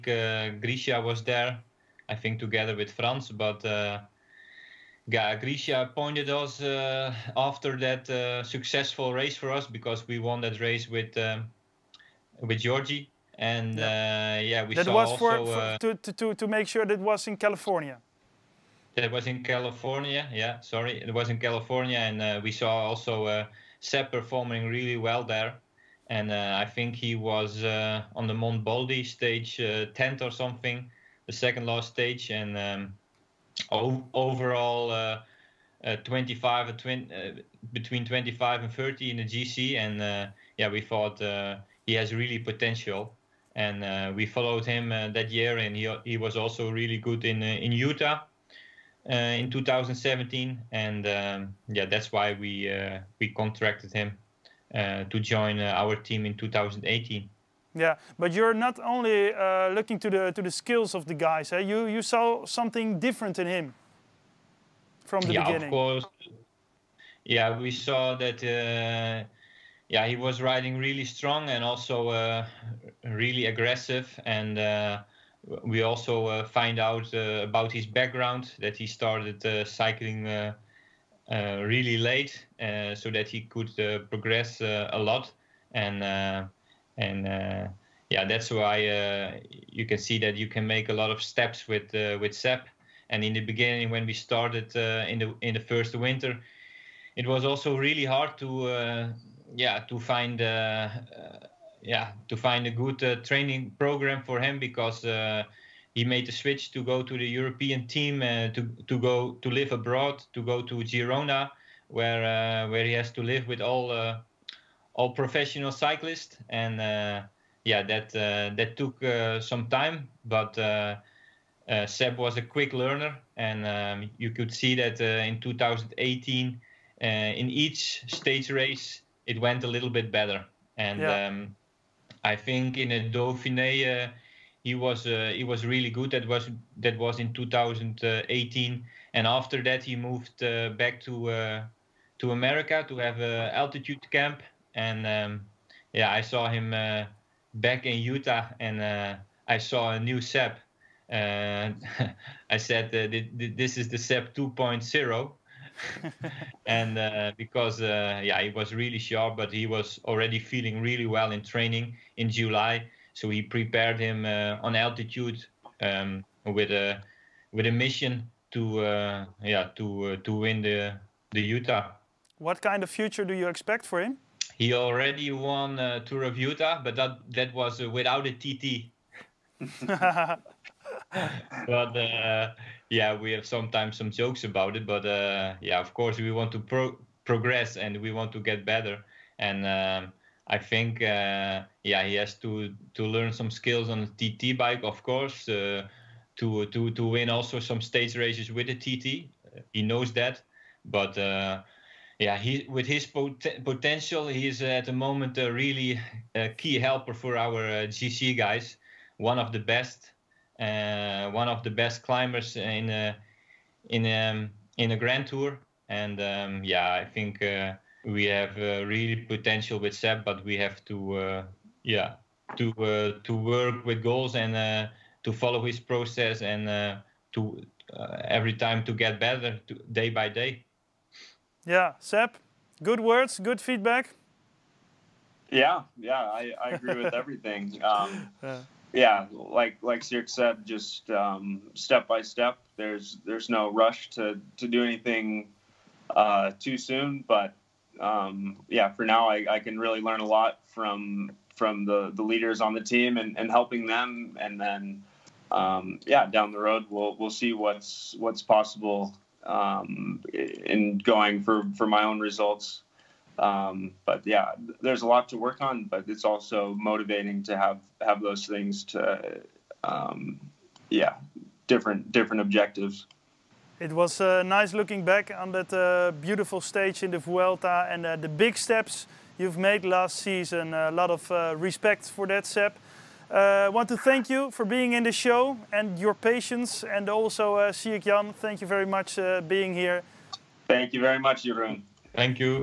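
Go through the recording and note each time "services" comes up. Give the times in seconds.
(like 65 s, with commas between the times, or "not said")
not said.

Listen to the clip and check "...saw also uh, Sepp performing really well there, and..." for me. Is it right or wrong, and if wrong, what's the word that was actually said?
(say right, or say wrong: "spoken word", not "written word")
right.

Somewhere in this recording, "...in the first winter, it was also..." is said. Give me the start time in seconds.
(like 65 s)
95 s.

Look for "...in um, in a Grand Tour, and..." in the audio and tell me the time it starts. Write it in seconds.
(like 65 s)
213 s.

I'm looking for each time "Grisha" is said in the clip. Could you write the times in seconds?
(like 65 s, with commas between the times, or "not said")
0 s, 5 s.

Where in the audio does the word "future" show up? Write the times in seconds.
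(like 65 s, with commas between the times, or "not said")
172 s.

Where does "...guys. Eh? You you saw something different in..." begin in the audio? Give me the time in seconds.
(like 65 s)
61 s.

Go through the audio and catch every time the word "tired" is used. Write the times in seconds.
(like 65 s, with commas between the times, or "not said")
not said.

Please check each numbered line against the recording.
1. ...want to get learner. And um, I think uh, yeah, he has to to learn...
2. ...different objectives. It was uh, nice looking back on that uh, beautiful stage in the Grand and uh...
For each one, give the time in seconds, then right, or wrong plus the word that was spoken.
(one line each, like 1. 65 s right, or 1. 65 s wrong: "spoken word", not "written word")
1. 188 s wrong: "better", not "learner"
2. 272 s wrong: "Vuelta", not "Grand".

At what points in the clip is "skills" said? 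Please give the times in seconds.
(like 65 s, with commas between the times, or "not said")
60 s, 193 s.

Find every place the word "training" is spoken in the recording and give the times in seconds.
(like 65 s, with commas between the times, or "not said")
103 s, 161 s.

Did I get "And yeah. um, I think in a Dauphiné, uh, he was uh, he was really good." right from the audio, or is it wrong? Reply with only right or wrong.
right.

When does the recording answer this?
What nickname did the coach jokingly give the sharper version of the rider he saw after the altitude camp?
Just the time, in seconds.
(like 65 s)
153 s.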